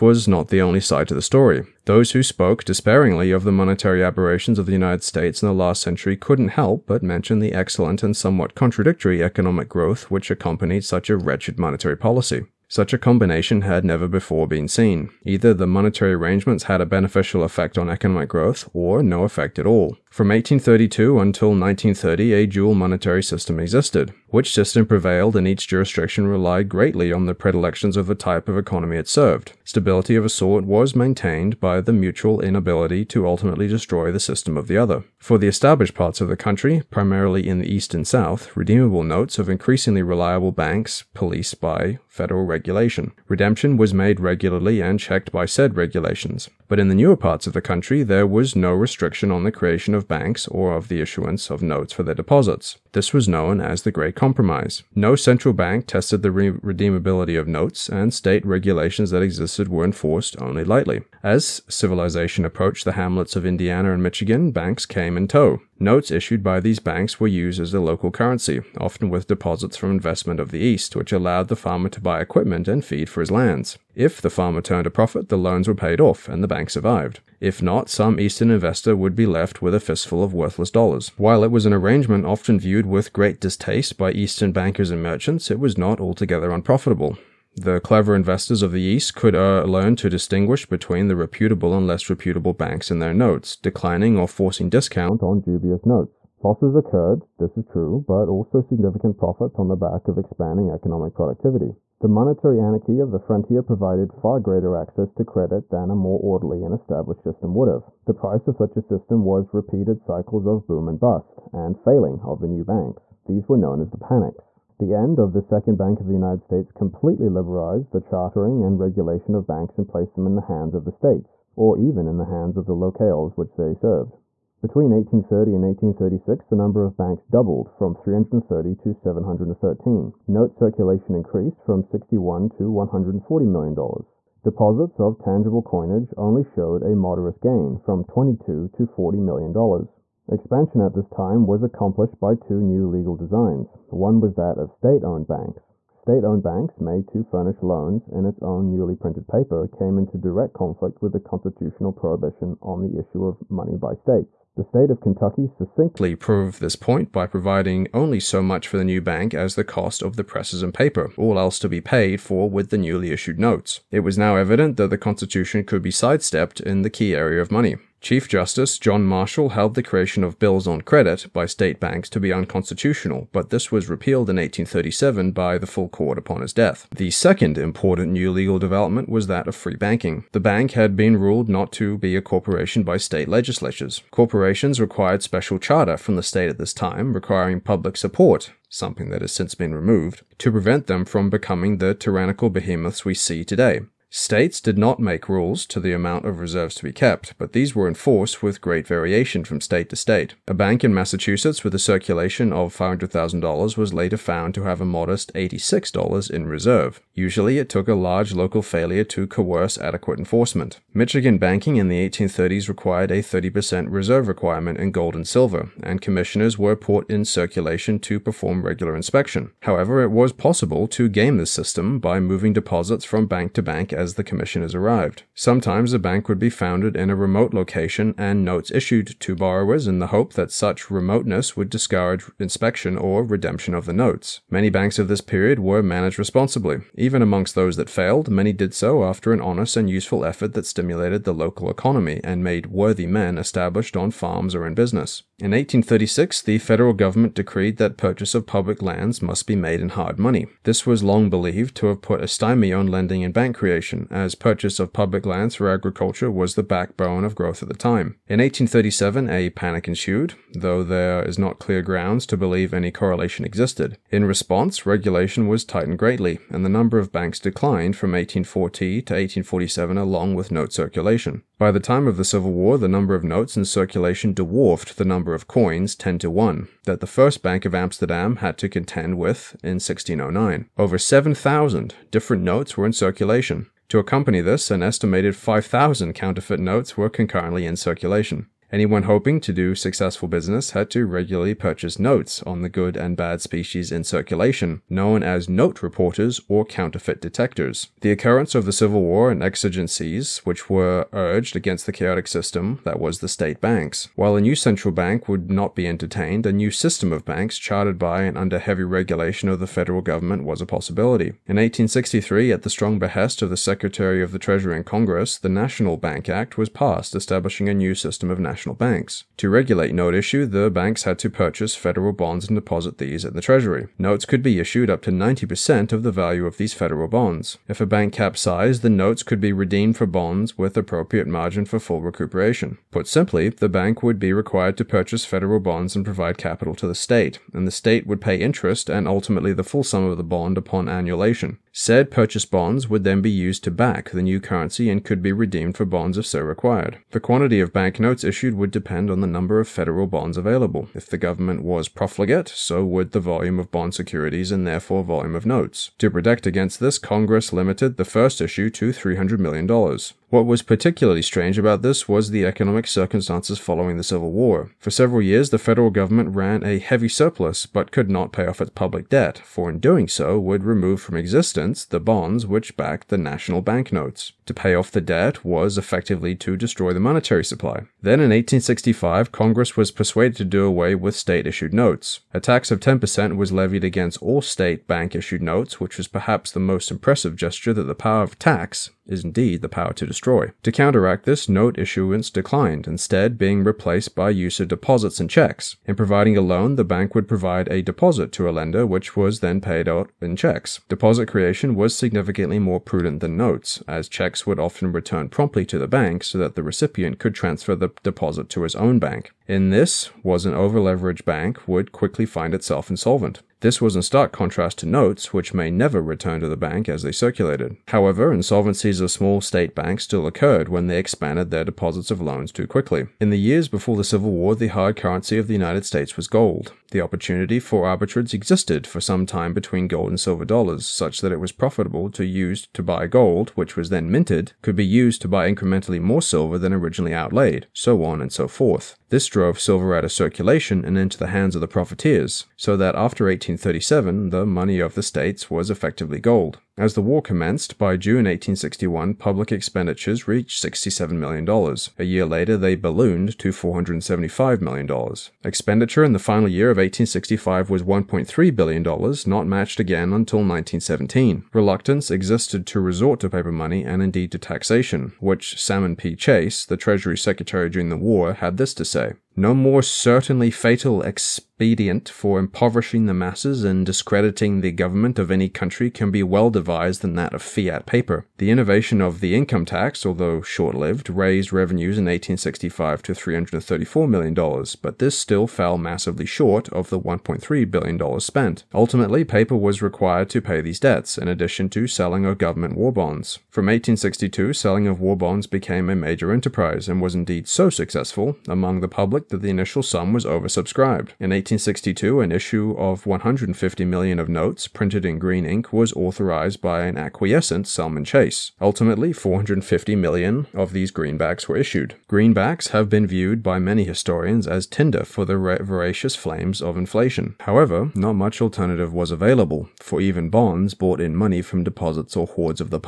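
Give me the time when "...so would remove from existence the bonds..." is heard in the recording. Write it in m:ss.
6:10.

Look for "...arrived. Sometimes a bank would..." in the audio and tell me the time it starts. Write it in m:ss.
3:44.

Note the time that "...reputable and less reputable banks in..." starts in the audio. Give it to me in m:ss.
1:31.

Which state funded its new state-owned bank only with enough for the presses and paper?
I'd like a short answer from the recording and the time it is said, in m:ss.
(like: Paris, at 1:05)
Kentucky, at 2:34.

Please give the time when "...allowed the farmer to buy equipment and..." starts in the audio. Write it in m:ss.
1:11.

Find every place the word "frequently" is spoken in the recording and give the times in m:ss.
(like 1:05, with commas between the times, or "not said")
not said.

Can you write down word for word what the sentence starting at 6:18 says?
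Then in 1865, Congress was persuaded to do away with state issued notes.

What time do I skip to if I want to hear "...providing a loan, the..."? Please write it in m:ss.
6:35.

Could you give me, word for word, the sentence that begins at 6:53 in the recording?
This was in stark contrast to notes, which may never return to the bank as they circulated.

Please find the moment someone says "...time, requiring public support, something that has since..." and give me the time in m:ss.
3:06.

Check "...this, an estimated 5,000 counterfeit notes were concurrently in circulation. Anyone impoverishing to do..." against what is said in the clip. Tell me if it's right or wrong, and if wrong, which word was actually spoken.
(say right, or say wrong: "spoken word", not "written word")
wrong: "hoping", not "impoverishing".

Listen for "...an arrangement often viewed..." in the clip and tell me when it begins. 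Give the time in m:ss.
1:21.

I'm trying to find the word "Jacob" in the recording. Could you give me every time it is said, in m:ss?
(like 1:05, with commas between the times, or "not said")
not said.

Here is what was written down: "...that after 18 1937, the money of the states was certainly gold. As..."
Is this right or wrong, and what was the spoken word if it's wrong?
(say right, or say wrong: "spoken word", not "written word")
wrong: "effectively", not "certainly".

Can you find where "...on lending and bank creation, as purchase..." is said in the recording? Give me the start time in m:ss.
4:12.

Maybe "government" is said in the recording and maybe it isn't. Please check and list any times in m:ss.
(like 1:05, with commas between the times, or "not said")
4:06, 5:10, 5:51, 6:05, 7:54, 8:12.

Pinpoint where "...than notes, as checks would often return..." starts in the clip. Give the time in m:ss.
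6:43.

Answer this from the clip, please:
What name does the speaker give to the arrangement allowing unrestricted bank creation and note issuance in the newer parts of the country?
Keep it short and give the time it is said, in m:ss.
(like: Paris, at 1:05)
The Great Compromise, at 0:53.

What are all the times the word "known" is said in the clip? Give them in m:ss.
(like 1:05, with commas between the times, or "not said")
0:53, 1:53, 4:54.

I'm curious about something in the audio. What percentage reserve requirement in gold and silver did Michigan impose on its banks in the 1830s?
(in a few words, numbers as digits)
30%.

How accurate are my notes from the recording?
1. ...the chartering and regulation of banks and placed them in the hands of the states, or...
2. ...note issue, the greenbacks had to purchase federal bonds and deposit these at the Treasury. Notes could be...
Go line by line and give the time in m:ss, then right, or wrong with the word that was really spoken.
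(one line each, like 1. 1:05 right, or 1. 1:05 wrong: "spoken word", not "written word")
1. 1:57 right
2. 5:19 wrong: "banks", not "greenbacks".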